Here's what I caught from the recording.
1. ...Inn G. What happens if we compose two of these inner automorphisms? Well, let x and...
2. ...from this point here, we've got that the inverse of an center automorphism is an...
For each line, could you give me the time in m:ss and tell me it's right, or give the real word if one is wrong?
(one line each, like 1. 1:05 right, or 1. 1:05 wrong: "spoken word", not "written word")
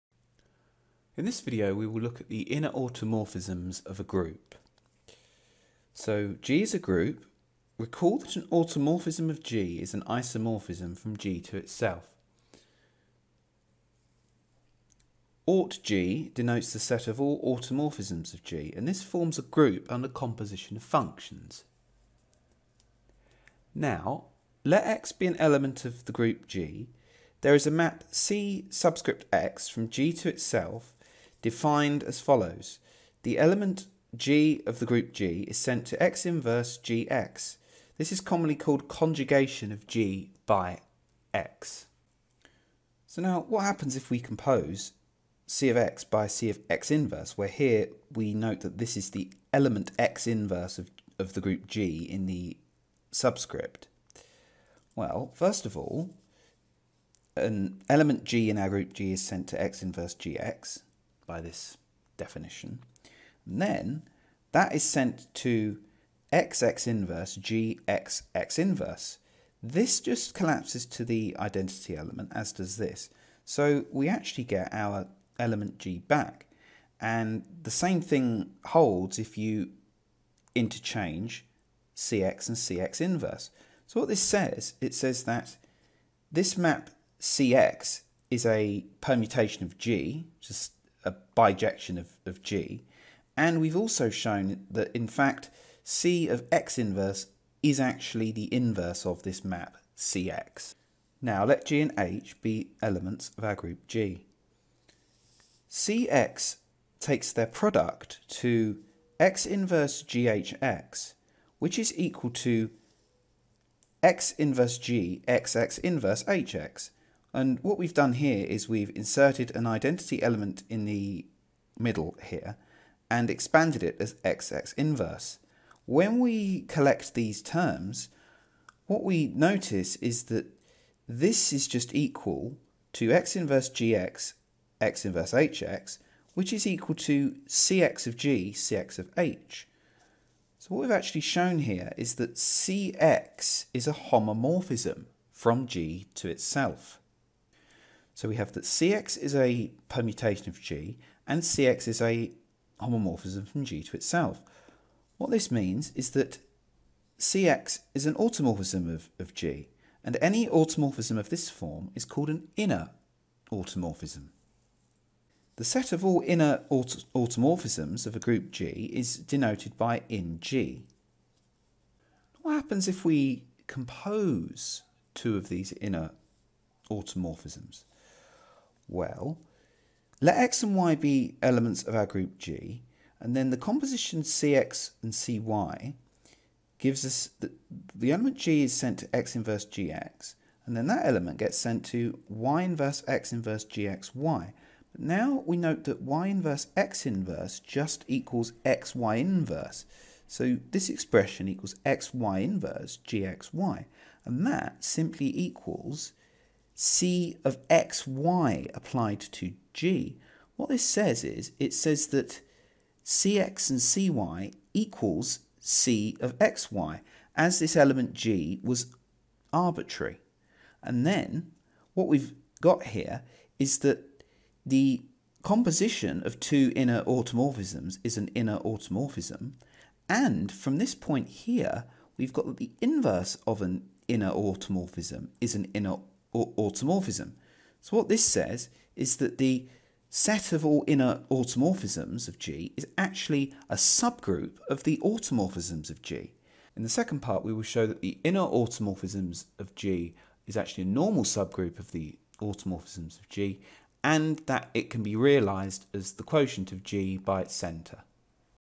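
1. 2:50 right
2. 3:50 wrong: "inner", not "center".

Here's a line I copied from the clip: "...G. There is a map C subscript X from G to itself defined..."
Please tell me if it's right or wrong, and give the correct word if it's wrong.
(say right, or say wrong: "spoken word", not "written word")
right.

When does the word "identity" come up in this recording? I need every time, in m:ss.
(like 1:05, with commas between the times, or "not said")
1:11, 1:59.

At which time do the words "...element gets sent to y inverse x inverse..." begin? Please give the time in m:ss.
3:11.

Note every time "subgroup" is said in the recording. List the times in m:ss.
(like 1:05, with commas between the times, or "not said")
4:03, 4:11.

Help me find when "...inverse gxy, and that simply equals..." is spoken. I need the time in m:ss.
3:22.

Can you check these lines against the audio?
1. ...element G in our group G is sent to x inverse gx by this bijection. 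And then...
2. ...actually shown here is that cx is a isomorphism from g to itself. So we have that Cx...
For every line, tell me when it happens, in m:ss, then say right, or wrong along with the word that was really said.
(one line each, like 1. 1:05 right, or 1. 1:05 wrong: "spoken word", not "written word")
1. 0:57 wrong: "definition", not "bijection"
2. 2:20 wrong: "homomorphism", not "isomorphism".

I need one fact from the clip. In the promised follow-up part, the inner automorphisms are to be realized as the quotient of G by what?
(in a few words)
its center.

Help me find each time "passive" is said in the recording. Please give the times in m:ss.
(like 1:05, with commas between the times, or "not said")
not said.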